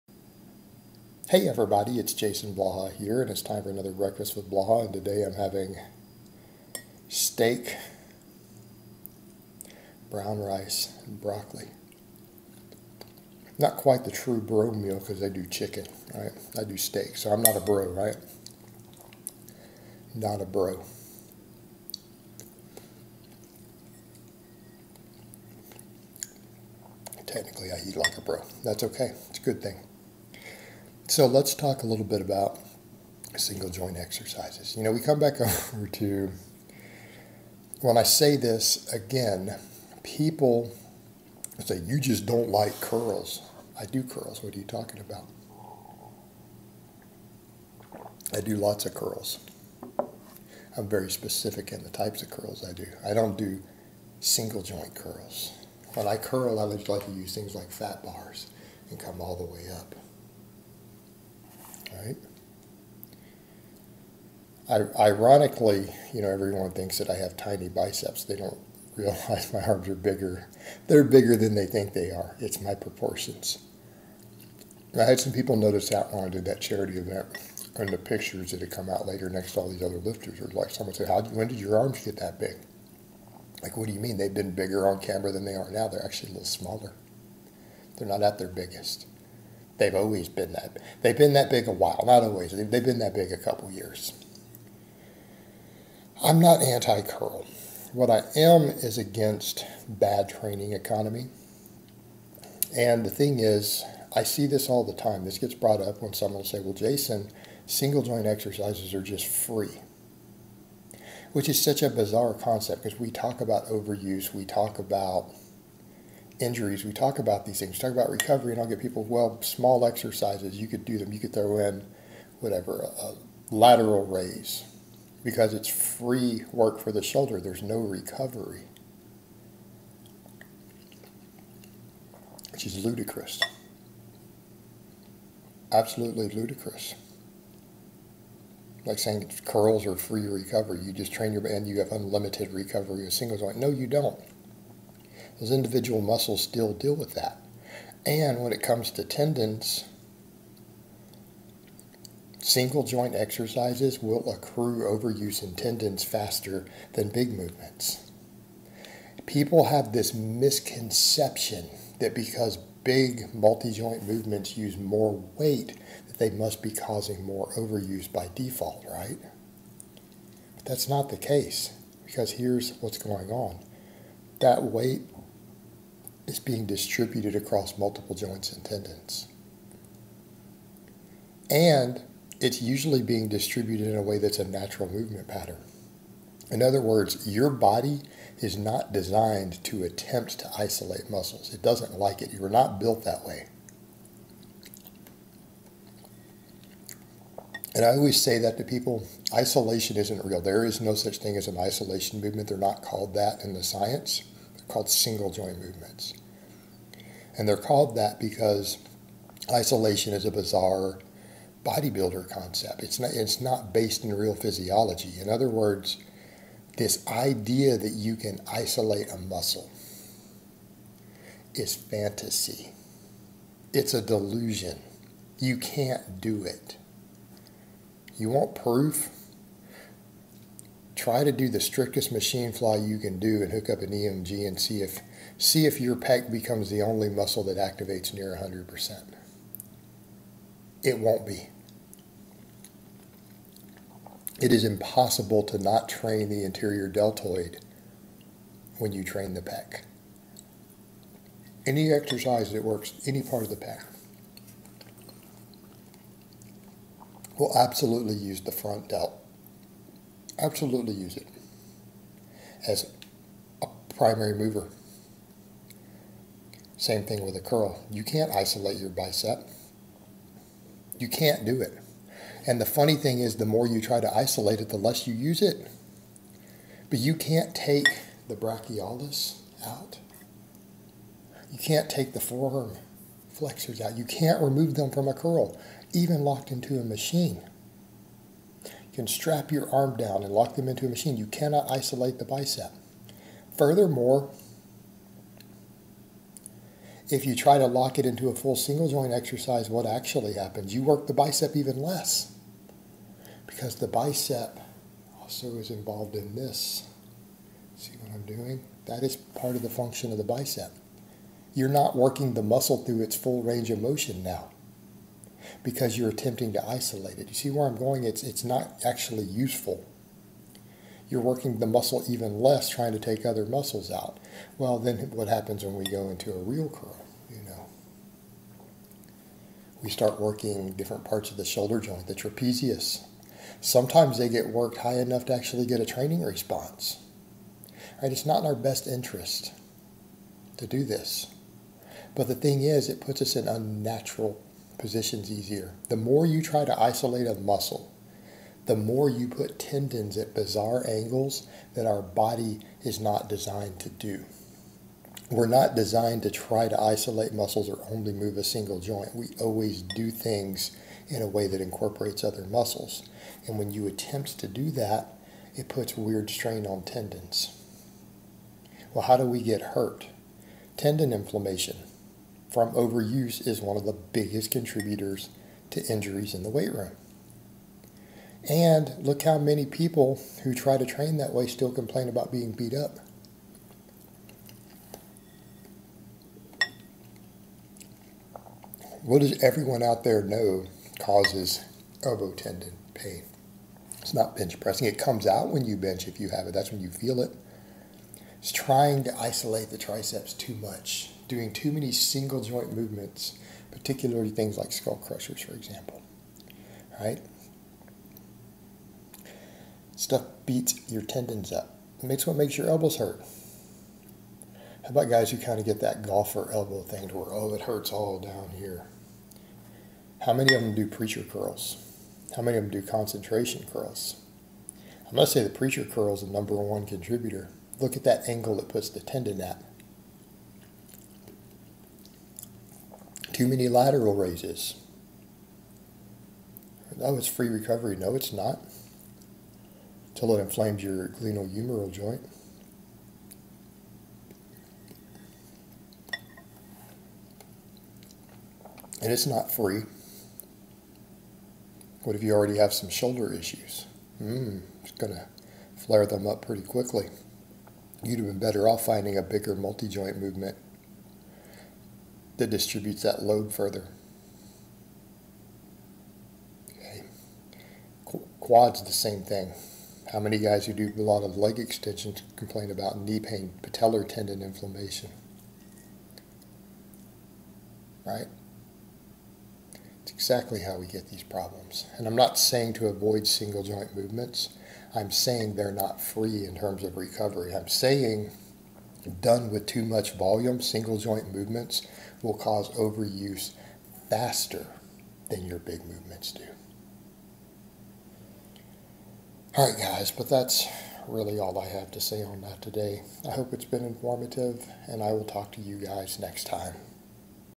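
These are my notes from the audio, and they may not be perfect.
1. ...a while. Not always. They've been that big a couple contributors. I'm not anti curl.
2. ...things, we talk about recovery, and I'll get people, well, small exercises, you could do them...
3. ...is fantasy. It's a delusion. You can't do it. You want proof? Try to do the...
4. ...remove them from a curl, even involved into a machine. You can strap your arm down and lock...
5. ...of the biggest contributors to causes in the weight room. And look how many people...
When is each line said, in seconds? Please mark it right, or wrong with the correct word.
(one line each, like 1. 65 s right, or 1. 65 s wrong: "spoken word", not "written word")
1. 91 s wrong: "years", not "contributors"
2. 117 s right
3. 221 s right
4. 284 s wrong: "locked", not "involved"
5. 373 s wrong: "injuries", not "causes".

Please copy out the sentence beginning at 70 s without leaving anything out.
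They're bigger than they think they are.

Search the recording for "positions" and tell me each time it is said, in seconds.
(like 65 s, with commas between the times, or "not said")
344 s.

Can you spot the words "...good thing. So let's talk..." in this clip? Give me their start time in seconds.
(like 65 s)
29 s.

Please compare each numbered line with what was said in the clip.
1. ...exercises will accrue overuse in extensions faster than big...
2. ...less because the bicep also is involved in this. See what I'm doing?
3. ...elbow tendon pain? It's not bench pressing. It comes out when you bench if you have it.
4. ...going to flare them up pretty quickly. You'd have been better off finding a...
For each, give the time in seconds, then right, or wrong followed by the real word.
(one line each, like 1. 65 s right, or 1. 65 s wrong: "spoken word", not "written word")
1. 153 s wrong: "tendons", not "extensions"
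2. 301 s right
3. 392 s right
4. 454 s right.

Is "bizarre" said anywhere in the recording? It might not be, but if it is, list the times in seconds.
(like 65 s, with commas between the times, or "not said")
111 s, 210 s, 350 s.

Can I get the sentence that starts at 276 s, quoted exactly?
But you can't take the brachialis out.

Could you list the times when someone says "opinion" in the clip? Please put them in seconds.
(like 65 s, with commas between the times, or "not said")
not said.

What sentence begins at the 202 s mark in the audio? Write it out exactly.
They're not called that in the science, they're called single joint movements.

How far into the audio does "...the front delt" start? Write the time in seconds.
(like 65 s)
258 s.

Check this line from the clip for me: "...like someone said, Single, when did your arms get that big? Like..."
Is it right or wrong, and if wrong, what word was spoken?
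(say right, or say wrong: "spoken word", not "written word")
wrong: "How", not "Single".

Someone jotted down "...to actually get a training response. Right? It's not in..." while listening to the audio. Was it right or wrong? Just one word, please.
right.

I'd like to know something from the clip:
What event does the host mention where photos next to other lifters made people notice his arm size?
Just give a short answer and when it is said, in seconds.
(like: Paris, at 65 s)
charity event, at 76 s.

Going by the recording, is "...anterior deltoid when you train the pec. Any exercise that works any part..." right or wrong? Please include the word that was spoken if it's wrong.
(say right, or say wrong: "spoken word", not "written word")
right.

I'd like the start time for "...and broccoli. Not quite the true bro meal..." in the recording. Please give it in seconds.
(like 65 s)
11 s.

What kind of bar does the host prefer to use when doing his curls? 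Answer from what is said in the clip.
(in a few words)
fat bars.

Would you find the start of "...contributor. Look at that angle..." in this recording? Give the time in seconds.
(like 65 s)
426 s.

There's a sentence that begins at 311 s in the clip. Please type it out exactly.
You're not working the muscle through its full range of motion now because you're attempting to isolate it.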